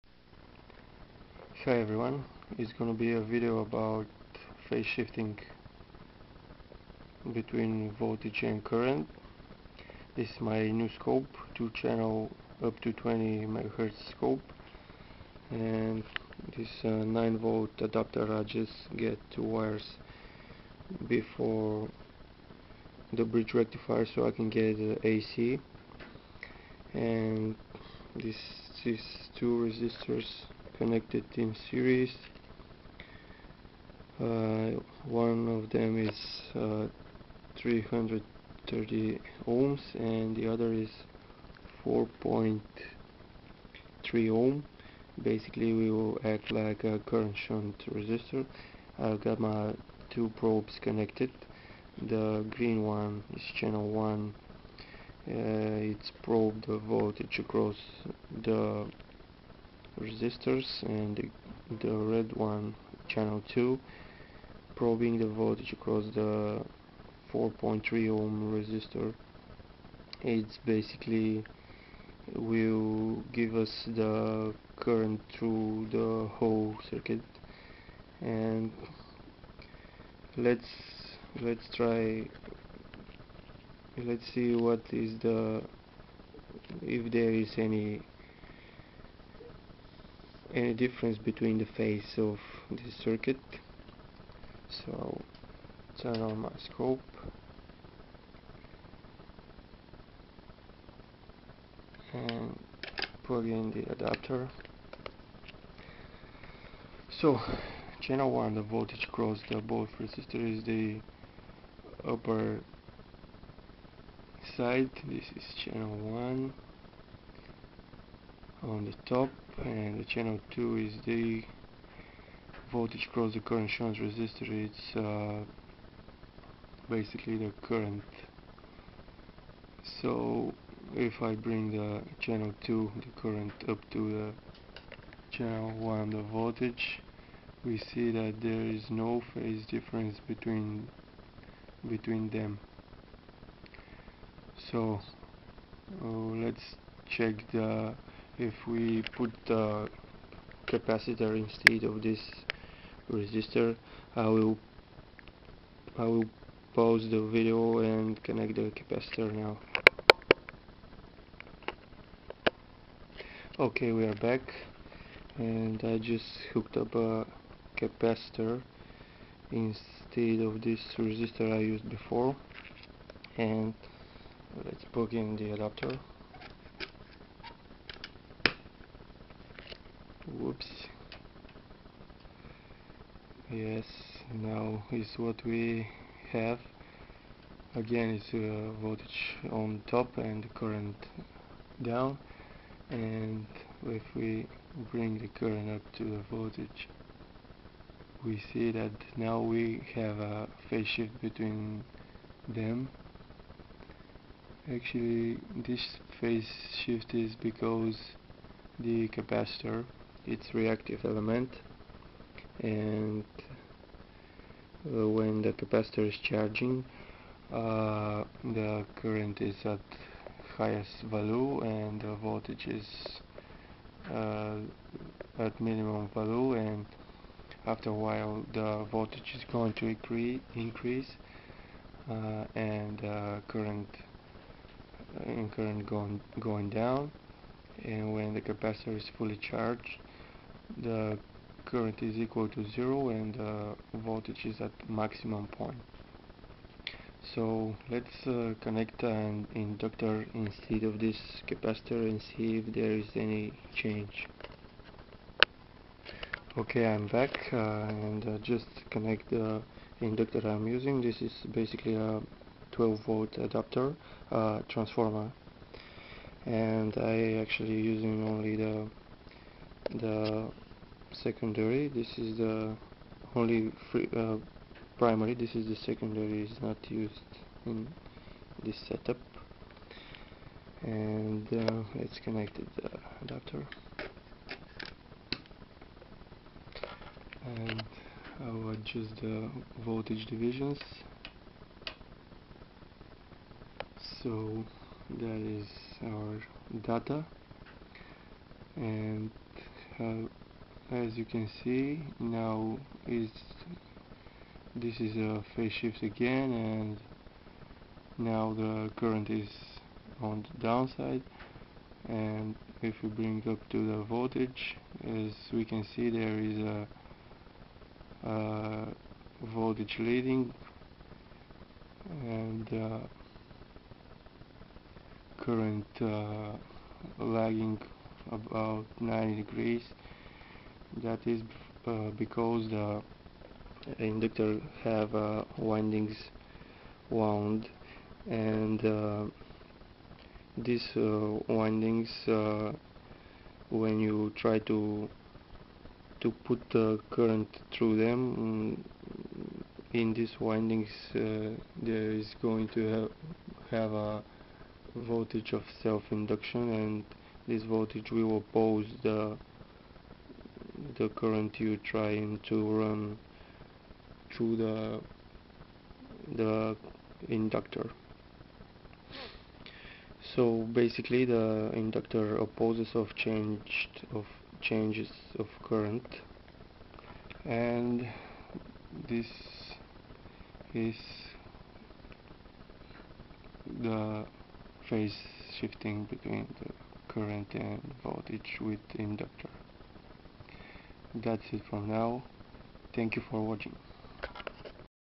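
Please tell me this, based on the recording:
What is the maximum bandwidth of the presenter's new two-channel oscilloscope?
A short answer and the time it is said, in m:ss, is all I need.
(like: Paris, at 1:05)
20 MHz, at 0:12.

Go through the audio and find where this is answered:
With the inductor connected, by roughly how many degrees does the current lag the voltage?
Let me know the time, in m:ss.
5:28.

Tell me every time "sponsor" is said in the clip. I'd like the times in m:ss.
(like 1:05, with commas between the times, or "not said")
not said.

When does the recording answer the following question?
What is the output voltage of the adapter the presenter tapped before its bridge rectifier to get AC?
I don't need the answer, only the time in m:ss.
0:17.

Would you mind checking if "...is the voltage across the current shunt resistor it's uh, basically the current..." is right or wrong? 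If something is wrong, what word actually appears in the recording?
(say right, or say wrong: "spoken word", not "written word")
right.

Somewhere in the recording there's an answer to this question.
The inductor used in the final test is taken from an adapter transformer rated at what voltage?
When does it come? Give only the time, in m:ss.
4:22.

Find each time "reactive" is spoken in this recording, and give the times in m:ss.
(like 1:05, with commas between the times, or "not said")
3:30.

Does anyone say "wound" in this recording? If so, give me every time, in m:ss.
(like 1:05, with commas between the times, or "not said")
5:37.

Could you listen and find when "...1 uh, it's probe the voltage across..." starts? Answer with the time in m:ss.
0:53.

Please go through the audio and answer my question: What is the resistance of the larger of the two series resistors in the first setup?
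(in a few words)
330 ohms.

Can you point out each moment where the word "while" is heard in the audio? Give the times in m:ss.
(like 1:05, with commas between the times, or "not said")
3:47.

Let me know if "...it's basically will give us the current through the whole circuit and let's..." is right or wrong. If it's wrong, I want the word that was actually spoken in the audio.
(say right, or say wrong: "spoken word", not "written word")
right.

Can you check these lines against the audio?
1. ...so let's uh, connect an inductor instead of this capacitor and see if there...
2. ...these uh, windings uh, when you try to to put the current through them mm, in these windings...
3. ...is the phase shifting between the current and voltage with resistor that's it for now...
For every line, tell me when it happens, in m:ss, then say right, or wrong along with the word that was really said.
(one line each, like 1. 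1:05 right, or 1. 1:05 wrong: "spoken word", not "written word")
1. 4:07 right
2. 5:40 right
3. 6:20 wrong: "inductor", not "resistor".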